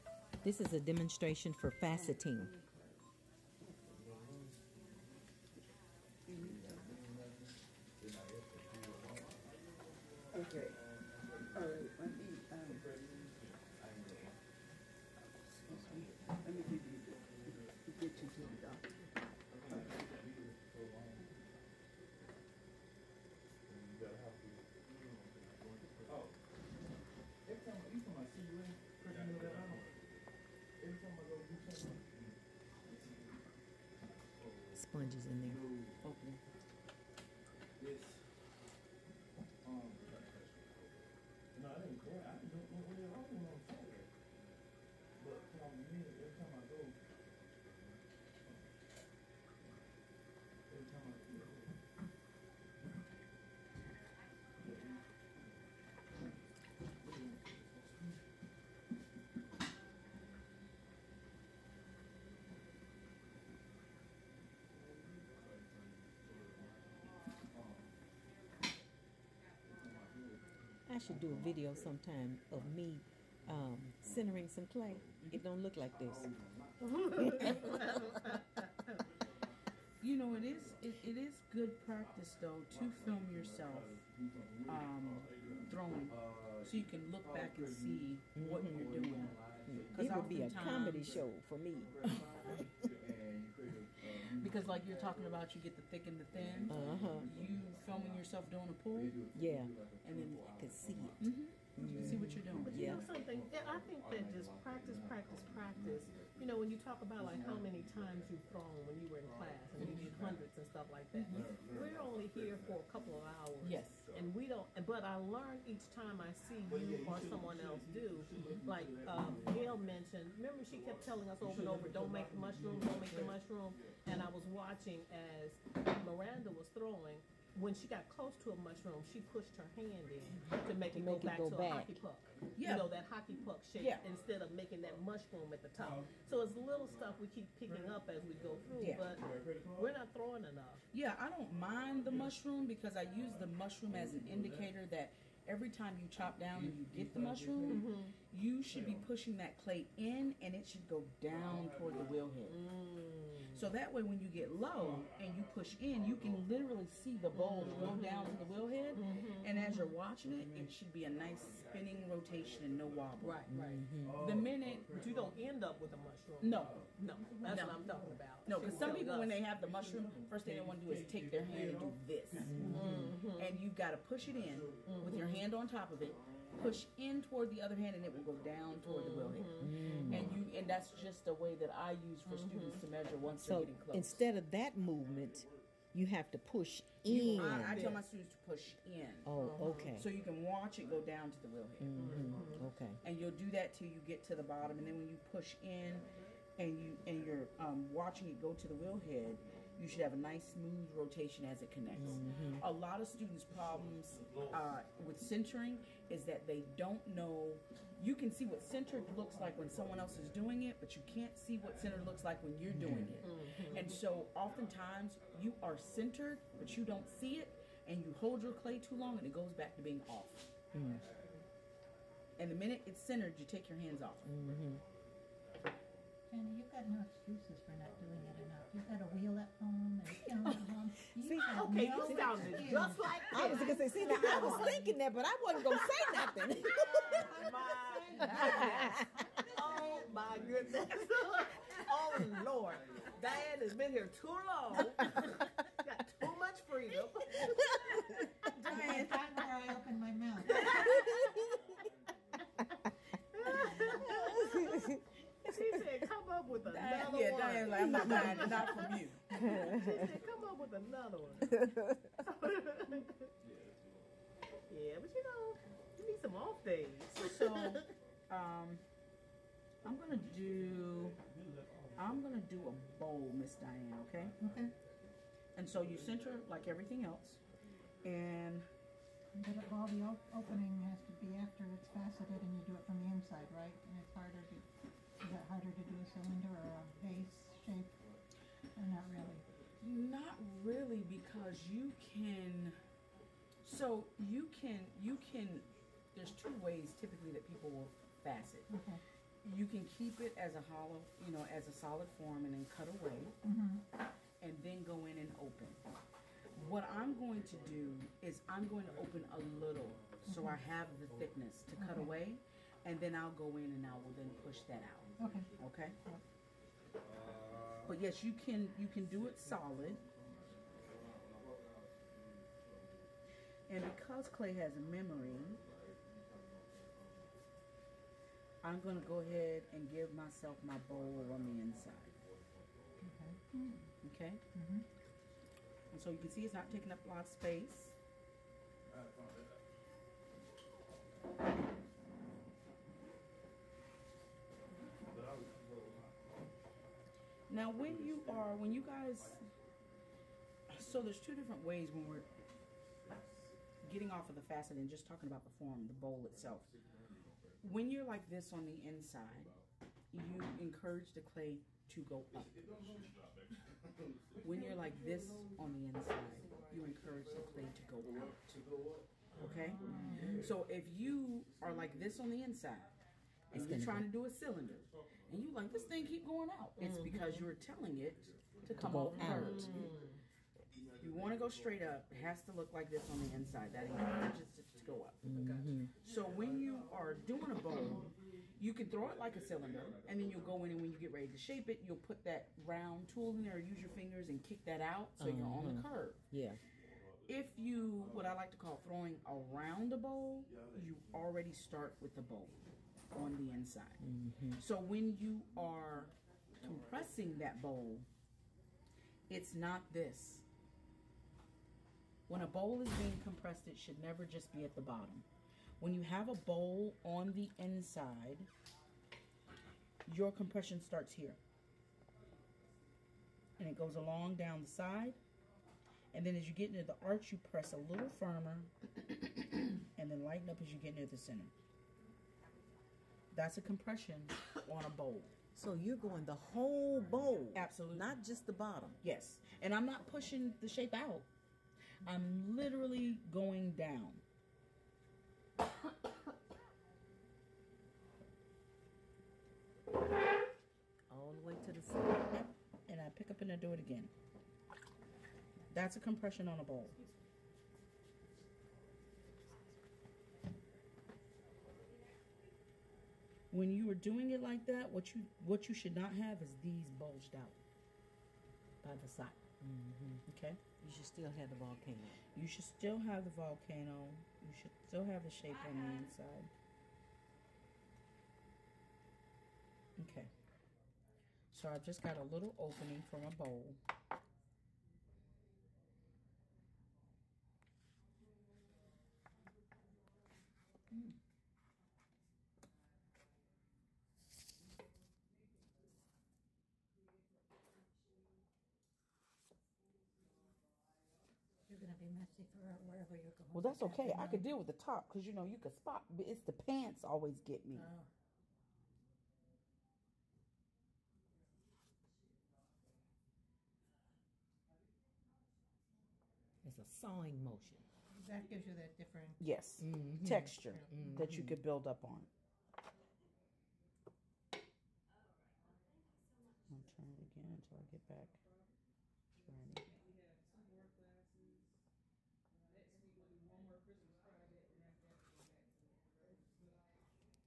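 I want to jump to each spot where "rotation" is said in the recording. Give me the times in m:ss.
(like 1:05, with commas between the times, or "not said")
2:42, 3:20.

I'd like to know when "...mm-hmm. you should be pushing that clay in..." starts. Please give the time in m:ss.
2:27.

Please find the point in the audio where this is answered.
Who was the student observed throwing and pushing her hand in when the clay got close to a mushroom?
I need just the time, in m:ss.
2:06.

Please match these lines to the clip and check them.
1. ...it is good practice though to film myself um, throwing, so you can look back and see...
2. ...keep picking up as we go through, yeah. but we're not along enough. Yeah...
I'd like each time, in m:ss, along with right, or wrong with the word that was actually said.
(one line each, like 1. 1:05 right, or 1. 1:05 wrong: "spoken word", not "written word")
1. 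1:21 wrong: "yourself", not "myself"
2. 2:17 wrong: "throwing", not "along".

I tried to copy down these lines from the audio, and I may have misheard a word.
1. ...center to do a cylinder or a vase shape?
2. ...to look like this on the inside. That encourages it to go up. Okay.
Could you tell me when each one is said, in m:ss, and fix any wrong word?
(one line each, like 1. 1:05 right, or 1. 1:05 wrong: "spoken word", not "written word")
1. 4:45 wrong: "harder", not "center"
2. 6:22 right.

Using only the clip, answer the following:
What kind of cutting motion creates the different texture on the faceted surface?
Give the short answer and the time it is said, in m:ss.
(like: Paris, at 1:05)
sawing motion, at 8:36.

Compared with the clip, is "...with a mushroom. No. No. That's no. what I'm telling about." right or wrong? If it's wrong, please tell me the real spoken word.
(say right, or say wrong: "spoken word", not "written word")
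wrong: "talking", not "telling".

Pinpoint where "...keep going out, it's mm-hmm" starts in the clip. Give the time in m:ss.
6:16.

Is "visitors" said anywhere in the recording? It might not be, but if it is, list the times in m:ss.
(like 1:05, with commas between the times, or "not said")
not said.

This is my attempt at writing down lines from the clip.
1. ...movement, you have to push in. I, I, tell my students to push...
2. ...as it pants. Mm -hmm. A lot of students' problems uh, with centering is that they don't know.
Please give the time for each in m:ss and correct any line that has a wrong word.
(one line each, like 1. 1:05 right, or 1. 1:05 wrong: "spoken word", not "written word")
1. 3:04 right
2. 3:21 wrong: "connects", not "pants".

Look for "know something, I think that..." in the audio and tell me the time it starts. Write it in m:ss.
1:42.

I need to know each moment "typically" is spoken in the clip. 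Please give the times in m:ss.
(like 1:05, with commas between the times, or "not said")
4:56.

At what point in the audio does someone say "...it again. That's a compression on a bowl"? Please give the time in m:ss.
7:33.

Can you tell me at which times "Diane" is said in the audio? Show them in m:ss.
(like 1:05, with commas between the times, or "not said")
4:03, 4:08, 4:33.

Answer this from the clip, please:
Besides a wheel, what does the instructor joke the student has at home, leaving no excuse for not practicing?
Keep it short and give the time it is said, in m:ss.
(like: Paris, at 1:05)
calendar, at 3:50.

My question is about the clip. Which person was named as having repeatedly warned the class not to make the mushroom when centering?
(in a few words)
Gail.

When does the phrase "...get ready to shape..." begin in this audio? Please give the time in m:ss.
6:30.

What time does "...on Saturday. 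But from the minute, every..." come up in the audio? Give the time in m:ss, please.
0:43.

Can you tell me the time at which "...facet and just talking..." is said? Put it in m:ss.
5:54.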